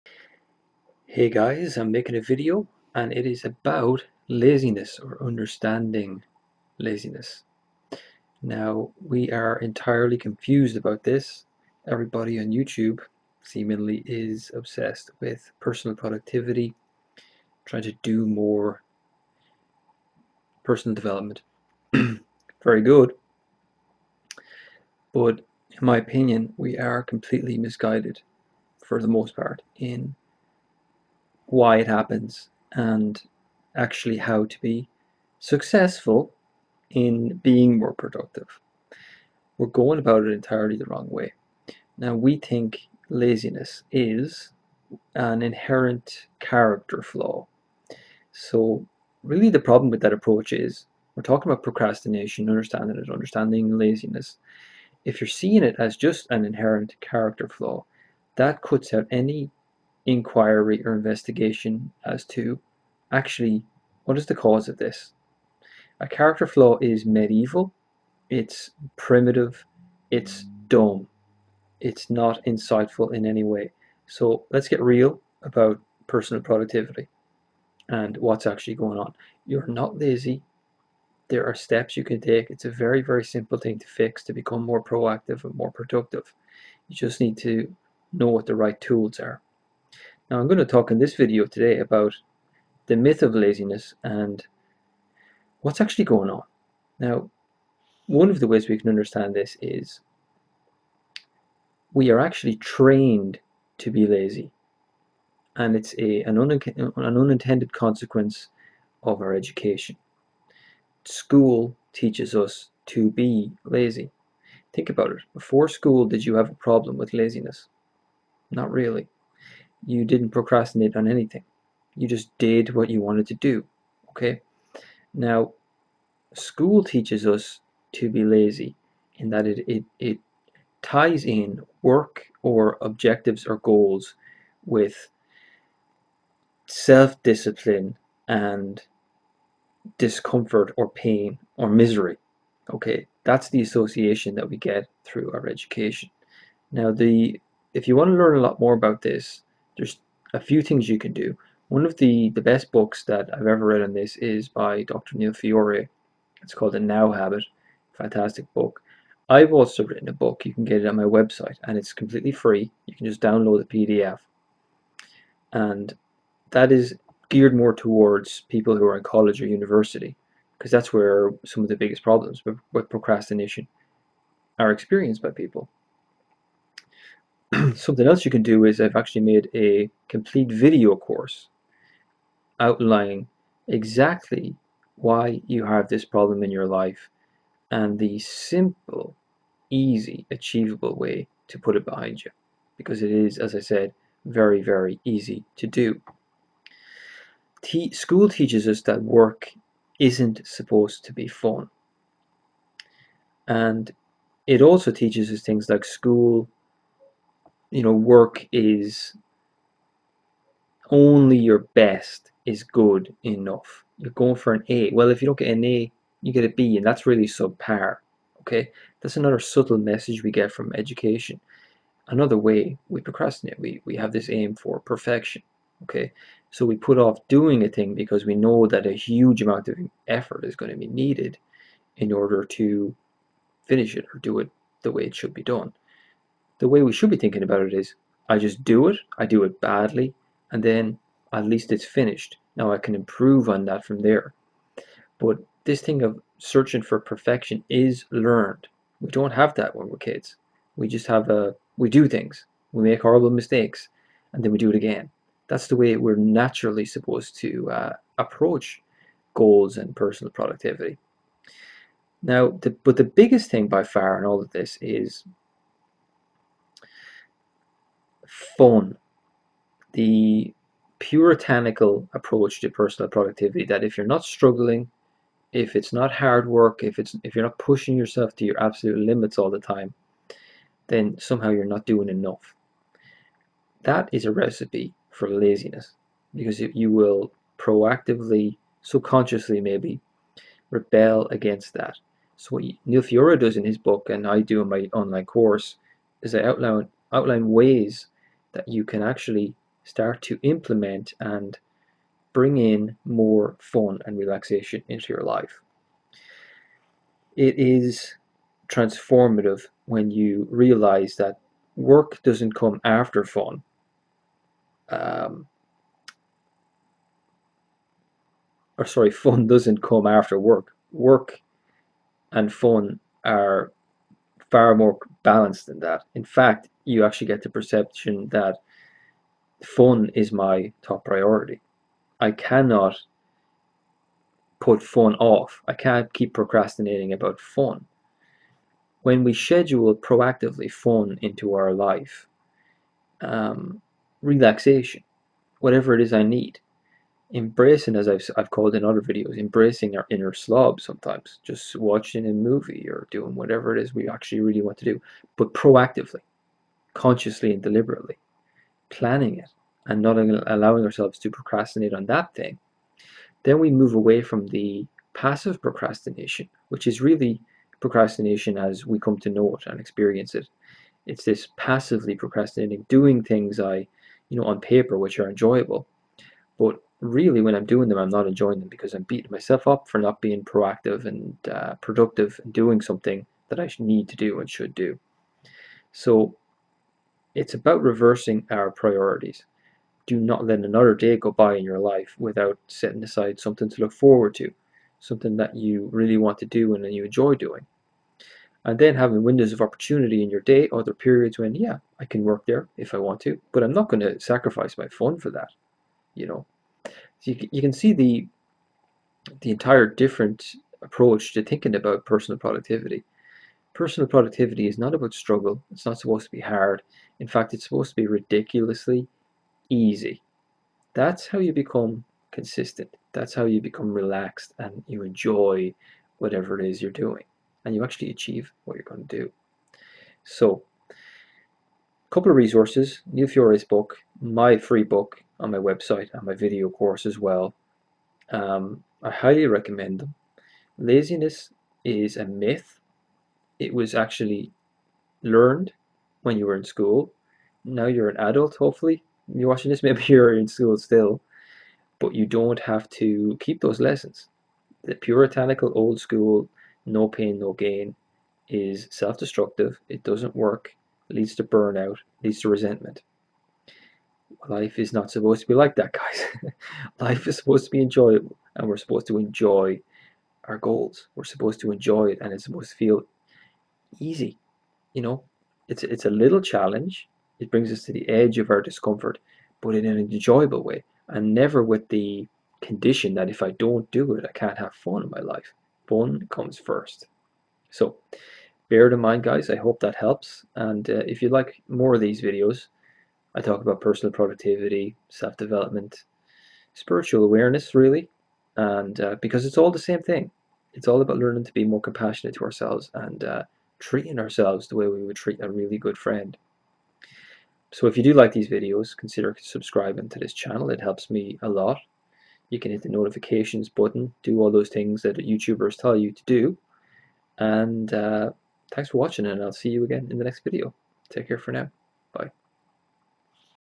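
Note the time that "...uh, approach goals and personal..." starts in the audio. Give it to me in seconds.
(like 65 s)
257 s.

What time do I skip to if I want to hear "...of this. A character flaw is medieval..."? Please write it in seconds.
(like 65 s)
64 s.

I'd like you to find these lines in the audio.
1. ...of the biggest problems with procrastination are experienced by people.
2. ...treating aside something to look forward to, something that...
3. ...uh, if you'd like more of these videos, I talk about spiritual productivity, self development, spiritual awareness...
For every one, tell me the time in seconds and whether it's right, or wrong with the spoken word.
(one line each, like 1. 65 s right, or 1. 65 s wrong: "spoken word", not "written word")
1. 171 s right
2. 392 s wrong: "setting", not "treating"
3. 490 s wrong: "personal", not "spiritual".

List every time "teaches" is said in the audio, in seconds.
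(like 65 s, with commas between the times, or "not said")
111 s, 126 s, 198 s, 204 s.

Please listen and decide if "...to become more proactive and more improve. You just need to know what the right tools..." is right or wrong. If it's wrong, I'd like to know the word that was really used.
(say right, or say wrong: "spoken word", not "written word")
wrong: "productive", not "improve".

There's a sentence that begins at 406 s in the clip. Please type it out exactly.
You know, so you, you can see the the entire different approach to thinking about personal productivity.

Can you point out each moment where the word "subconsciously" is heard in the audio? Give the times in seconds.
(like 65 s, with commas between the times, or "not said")
288 s.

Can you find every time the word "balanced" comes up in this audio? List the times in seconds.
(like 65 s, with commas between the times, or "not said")
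325 s.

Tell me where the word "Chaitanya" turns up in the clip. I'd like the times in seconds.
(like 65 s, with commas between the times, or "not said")
not said.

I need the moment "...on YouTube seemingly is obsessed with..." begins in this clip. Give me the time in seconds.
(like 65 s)
12 s.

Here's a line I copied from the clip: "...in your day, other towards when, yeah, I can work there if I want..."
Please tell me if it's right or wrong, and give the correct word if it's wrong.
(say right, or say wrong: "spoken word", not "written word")
wrong: "periods", not "towards".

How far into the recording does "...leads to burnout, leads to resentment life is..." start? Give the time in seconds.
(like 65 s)
461 s.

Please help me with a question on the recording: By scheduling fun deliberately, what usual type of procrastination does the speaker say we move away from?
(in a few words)
Passive procrastination.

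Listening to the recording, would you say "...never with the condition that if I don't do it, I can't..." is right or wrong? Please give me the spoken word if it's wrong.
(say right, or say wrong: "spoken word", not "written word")
right.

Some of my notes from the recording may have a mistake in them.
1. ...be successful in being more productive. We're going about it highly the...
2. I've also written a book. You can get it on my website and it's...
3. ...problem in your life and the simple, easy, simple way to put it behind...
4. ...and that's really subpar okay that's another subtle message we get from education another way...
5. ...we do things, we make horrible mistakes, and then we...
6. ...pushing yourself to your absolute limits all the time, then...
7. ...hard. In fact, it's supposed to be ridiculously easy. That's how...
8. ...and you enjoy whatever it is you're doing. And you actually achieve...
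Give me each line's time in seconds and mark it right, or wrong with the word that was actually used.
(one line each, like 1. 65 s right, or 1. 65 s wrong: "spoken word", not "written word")
1. 34 s wrong: "entirely", not "highly"
2. 159 s right
3. 186 s wrong: "achievable", not "simple"
4. 216 s right
5. 251 s right
6. 277 s right
7. 416 s right
8. 424 s right.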